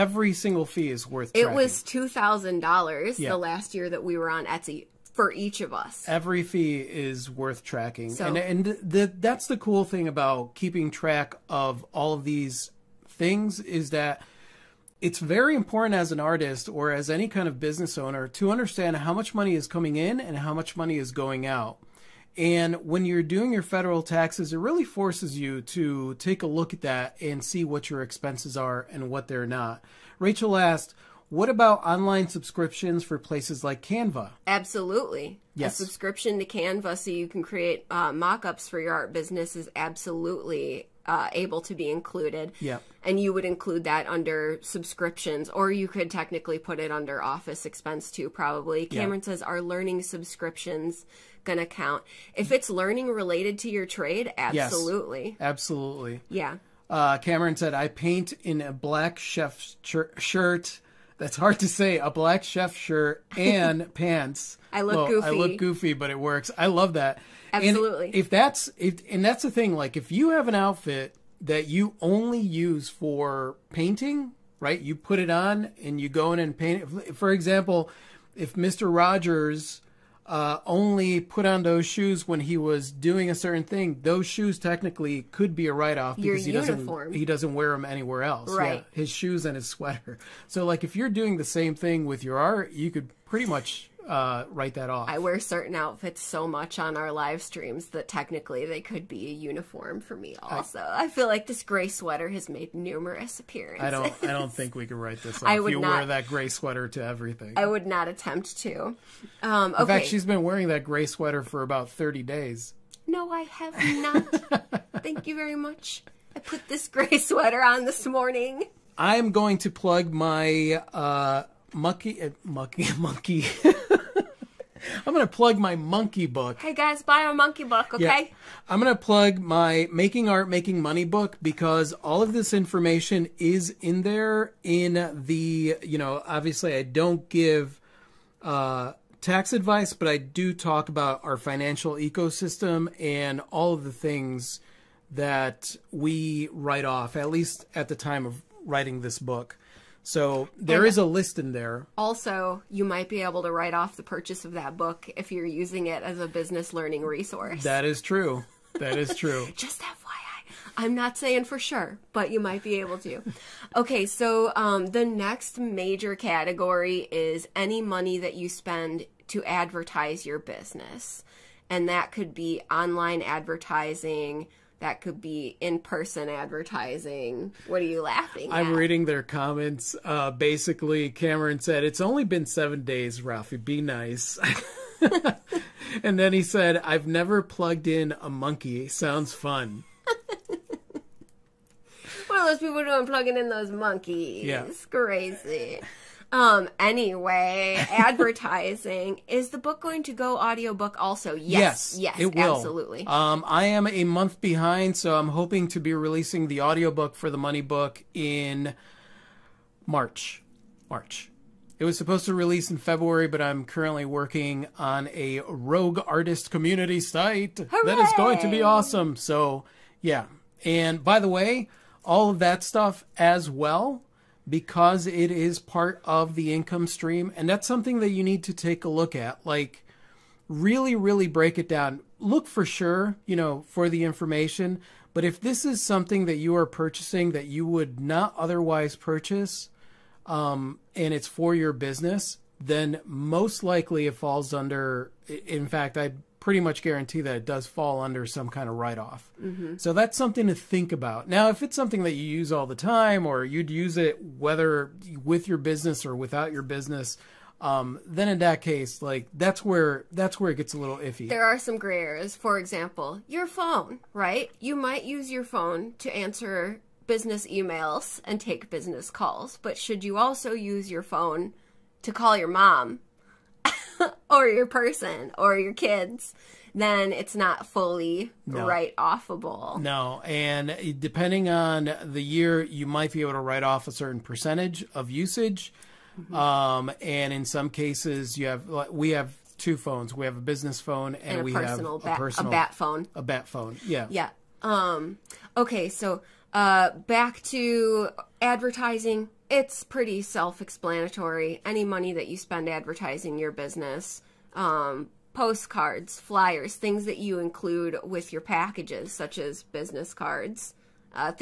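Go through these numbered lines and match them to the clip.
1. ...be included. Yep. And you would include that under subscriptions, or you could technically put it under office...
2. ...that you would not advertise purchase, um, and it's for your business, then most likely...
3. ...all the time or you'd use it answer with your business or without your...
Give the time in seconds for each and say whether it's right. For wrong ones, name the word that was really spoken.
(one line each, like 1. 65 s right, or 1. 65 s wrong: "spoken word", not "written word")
1. 41 s right
2. 237 s wrong: "otherwise", not "advertise"
3. 252 s wrong: "whether", not "answer".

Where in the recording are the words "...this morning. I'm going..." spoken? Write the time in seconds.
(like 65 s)
117 s.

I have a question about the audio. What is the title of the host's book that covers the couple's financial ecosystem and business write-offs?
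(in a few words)
Making Art, Making Money.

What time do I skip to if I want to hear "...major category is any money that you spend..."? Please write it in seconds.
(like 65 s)
165 s.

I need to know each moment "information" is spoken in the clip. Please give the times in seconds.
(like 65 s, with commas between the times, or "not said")
132 s, 234 s.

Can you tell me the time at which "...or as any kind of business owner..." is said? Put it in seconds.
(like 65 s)
16 s.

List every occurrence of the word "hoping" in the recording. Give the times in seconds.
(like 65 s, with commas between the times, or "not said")
205 s.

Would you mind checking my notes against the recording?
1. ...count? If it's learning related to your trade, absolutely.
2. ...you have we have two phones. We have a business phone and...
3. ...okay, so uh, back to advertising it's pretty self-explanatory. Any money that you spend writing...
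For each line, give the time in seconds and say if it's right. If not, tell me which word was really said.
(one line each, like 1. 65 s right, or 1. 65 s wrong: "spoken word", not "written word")
1. 51 s right
2. 288 s right
3. 295 s wrong: "advertising", not "writing".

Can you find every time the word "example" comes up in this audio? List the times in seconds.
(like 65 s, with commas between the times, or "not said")
77 s, 262 s.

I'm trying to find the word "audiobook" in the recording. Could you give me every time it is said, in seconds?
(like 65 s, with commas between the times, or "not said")
200 s, 206 s.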